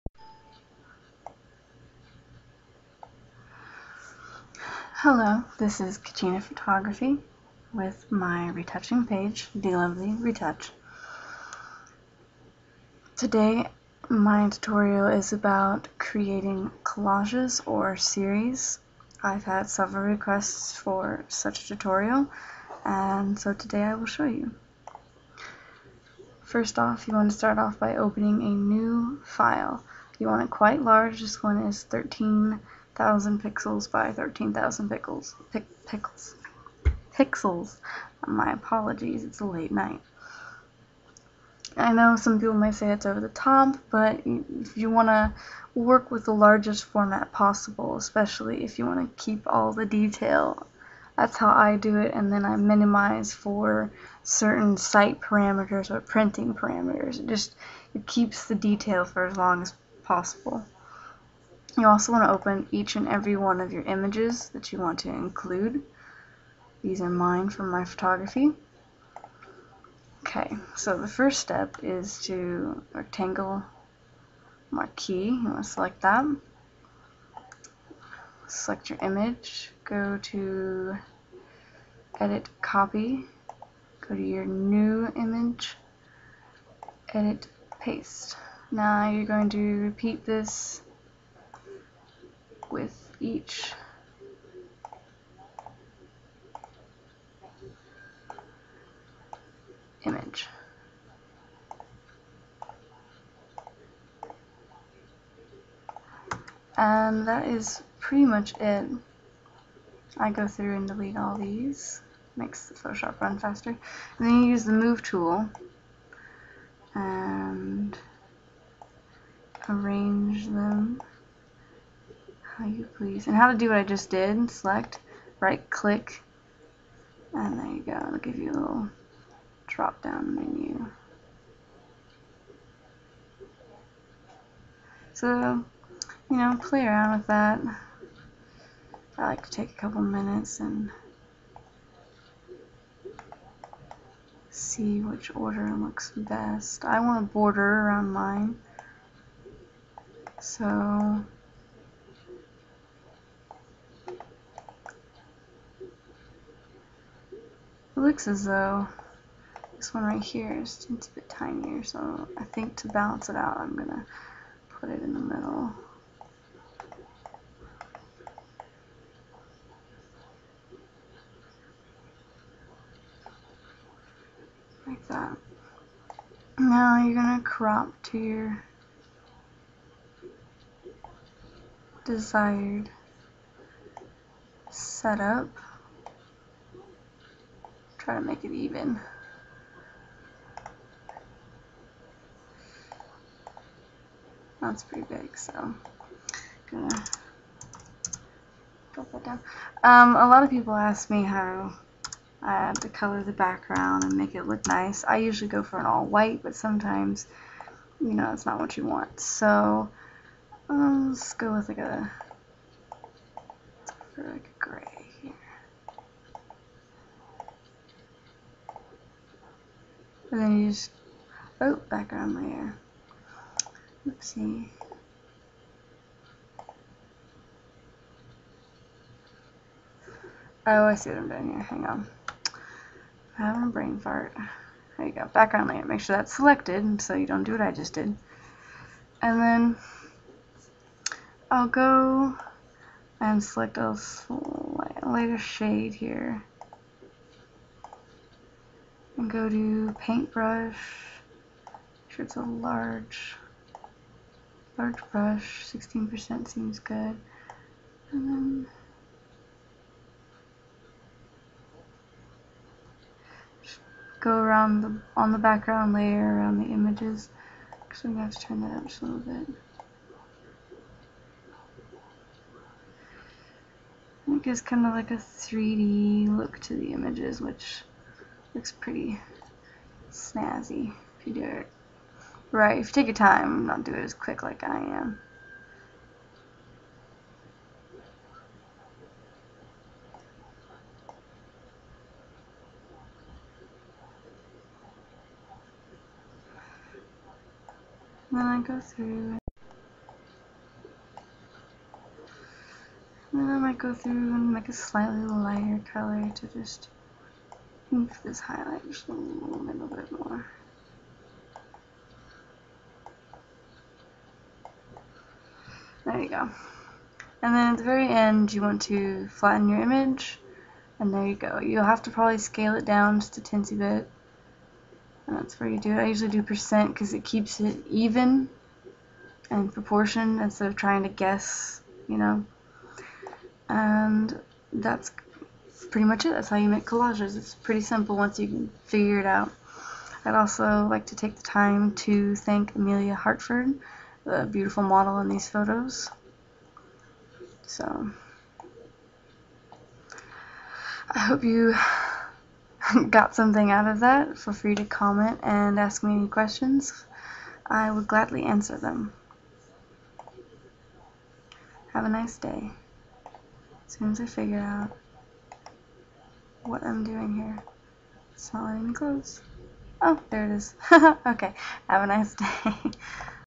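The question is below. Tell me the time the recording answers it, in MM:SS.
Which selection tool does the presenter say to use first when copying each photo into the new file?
01:12.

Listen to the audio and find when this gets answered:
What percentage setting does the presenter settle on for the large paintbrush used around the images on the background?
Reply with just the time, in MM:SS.
04:15.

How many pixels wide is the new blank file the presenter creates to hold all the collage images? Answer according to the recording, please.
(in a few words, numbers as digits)
13,000.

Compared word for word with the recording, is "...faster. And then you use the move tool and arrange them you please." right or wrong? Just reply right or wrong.
right.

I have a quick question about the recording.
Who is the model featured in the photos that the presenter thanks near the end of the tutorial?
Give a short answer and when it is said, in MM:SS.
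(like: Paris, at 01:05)
Emelia Hartford, at 05:42.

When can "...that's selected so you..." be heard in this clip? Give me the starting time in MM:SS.
03:56.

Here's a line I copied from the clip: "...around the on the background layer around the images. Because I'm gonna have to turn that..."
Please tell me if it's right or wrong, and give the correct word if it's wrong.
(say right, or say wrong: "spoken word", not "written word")
right.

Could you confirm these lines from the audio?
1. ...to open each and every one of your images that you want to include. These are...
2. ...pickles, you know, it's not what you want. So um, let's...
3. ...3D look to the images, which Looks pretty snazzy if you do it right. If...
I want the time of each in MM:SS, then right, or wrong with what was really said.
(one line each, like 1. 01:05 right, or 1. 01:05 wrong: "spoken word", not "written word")
1. 01:02 right
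2. 03:26 wrong: "sometimes", not "pickles"
3. 04:35 right.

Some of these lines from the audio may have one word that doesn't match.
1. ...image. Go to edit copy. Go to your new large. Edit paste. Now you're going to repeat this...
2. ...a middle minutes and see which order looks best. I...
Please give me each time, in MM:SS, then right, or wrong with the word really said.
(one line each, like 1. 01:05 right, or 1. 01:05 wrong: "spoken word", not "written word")
1. 01:19 wrong: "image", not "large"
2. 02:19 wrong: "couple", not "middle".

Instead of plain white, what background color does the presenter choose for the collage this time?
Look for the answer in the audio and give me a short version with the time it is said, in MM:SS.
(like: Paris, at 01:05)
Gray, at 03:34.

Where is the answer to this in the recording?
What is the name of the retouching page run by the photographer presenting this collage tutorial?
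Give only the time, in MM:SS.
00:09.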